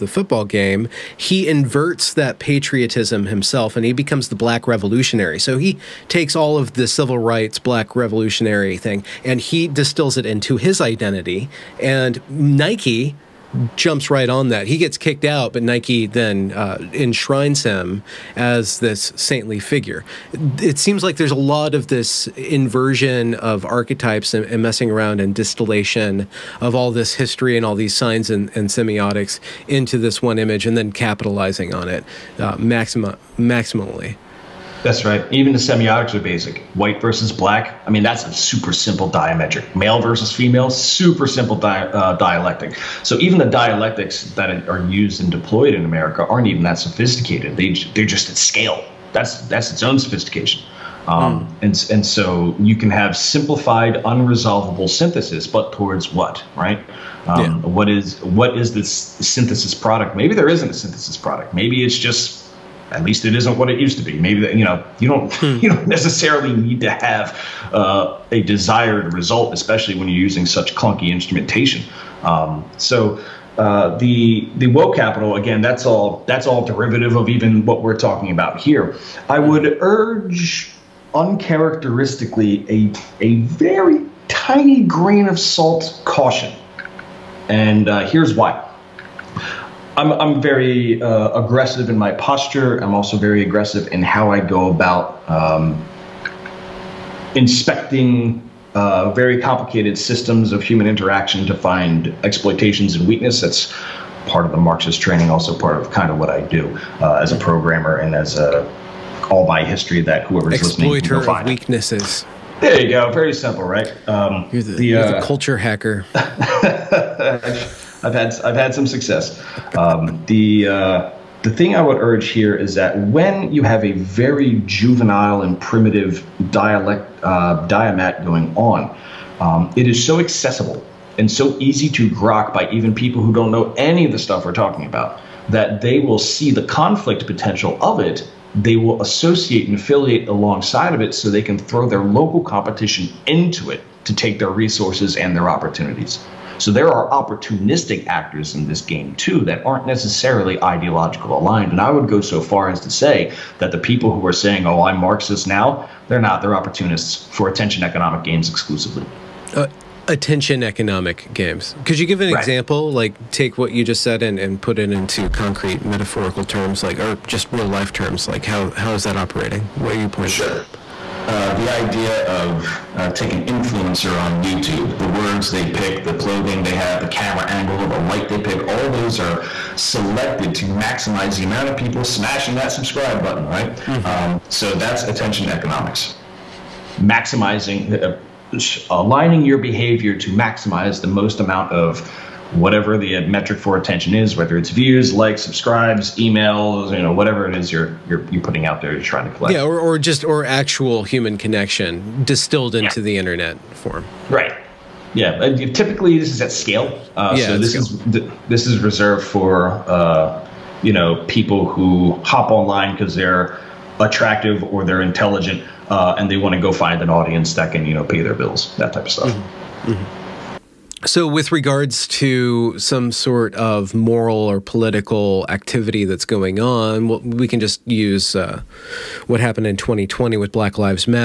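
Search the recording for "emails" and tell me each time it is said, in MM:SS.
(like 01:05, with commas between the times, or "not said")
03:16.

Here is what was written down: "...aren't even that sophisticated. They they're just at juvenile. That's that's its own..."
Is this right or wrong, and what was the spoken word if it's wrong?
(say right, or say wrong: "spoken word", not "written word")
wrong: "scale", not "juvenile".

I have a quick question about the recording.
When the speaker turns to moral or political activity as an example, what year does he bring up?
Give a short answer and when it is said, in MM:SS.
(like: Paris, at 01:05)
2020, at 03:49.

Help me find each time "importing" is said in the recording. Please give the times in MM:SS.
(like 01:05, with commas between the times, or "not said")
not said.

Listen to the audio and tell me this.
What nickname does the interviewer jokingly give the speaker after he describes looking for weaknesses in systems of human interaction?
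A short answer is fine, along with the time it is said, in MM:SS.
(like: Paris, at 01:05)
the culture hacker, at 01:55.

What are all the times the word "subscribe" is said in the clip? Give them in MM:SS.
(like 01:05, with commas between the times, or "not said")
03:02, 03:15.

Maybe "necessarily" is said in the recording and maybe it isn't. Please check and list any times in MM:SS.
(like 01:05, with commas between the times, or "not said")
01:05, 02:29.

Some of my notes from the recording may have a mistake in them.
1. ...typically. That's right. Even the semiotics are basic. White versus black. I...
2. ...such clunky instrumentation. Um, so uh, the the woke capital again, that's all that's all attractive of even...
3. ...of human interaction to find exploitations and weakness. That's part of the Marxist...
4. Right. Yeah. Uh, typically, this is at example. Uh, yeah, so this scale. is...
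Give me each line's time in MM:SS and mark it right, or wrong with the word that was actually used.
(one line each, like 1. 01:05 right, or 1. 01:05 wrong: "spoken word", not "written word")
1. 00:33 wrong: "maximally", not "typically"
2. 01:10 wrong: "derivative", not "attractive"
3. 01:40 right
4. 03:24 wrong: "scale", not "example".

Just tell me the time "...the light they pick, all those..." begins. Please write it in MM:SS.
02:57.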